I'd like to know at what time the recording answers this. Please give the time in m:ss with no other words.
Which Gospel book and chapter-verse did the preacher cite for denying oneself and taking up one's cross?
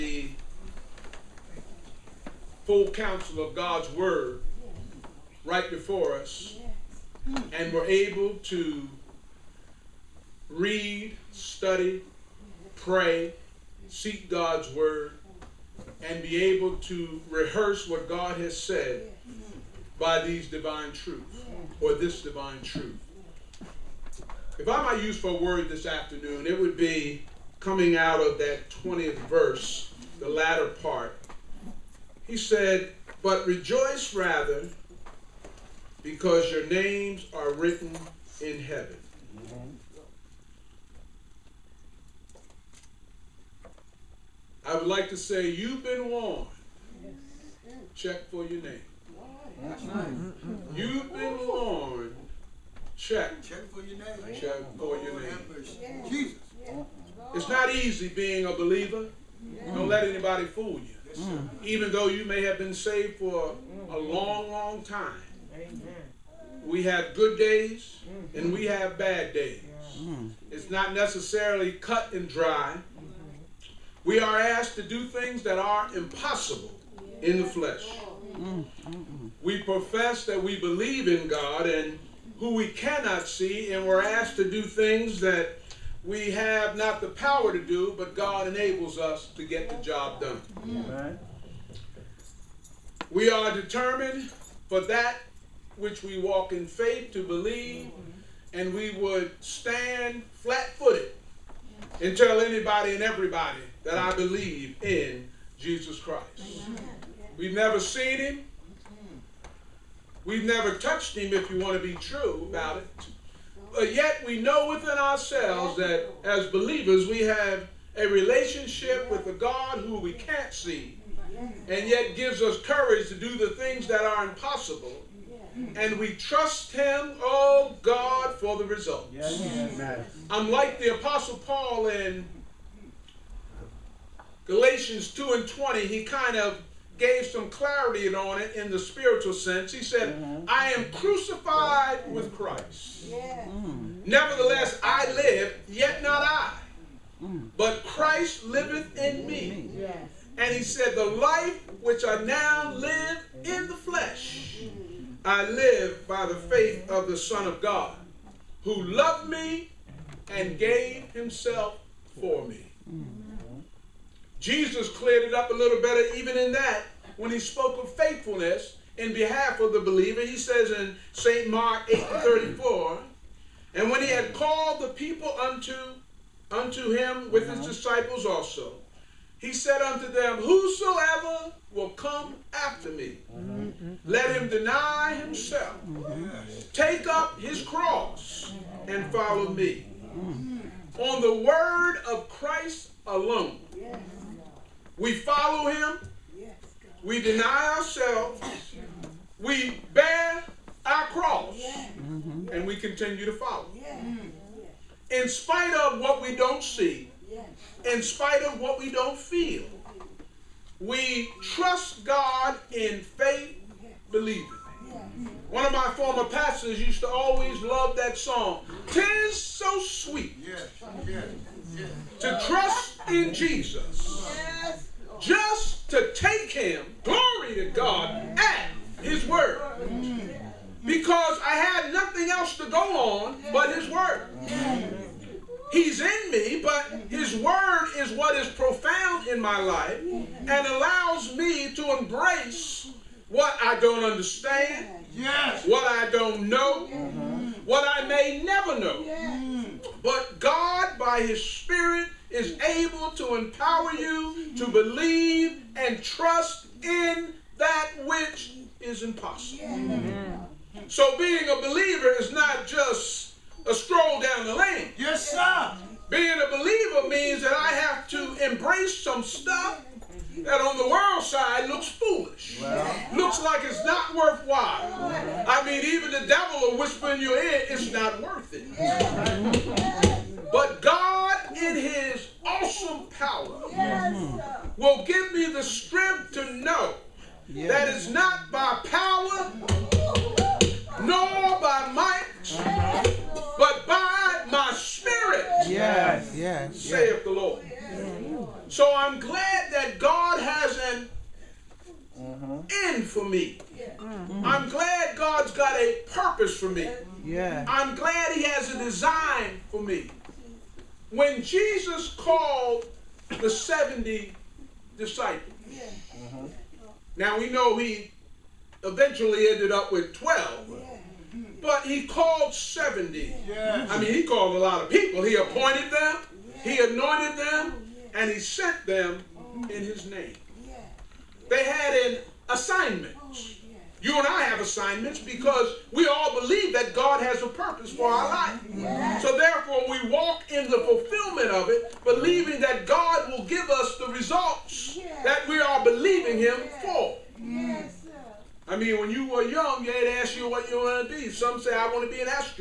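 2:51.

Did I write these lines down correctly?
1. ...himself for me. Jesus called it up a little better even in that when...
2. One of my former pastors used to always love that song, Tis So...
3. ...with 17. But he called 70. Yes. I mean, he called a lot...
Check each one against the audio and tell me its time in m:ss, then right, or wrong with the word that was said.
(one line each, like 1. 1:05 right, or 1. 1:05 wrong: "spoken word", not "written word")
1. 2:41 wrong: "cleared", not "called"
2. 3:35 right
3. 5:19 wrong: "12", not "17".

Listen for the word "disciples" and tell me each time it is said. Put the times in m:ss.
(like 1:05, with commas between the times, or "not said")
2:57, 5:14.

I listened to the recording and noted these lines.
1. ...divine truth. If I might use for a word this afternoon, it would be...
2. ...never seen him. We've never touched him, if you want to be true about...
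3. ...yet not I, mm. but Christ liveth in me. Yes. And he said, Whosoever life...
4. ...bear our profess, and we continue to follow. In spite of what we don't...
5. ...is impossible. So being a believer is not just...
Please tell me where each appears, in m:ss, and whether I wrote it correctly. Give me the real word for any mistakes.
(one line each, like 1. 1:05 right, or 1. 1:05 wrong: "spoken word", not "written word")
1. 0:22 right
2. 1:47 right
3. 2:25 wrong: "The", not "Whosoever"
4. 3:19 wrong: "cross", not "profess"
5. 4:18 right.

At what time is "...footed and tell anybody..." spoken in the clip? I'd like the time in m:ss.
1:40.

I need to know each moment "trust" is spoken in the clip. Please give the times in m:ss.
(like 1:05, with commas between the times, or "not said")
2:06, 3:31, 3:42, 4:16.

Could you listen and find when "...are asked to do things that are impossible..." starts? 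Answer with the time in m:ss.
1:14.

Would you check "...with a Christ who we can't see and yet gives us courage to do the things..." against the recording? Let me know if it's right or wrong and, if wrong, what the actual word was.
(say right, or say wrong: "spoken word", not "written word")
wrong: "God", not "Christ".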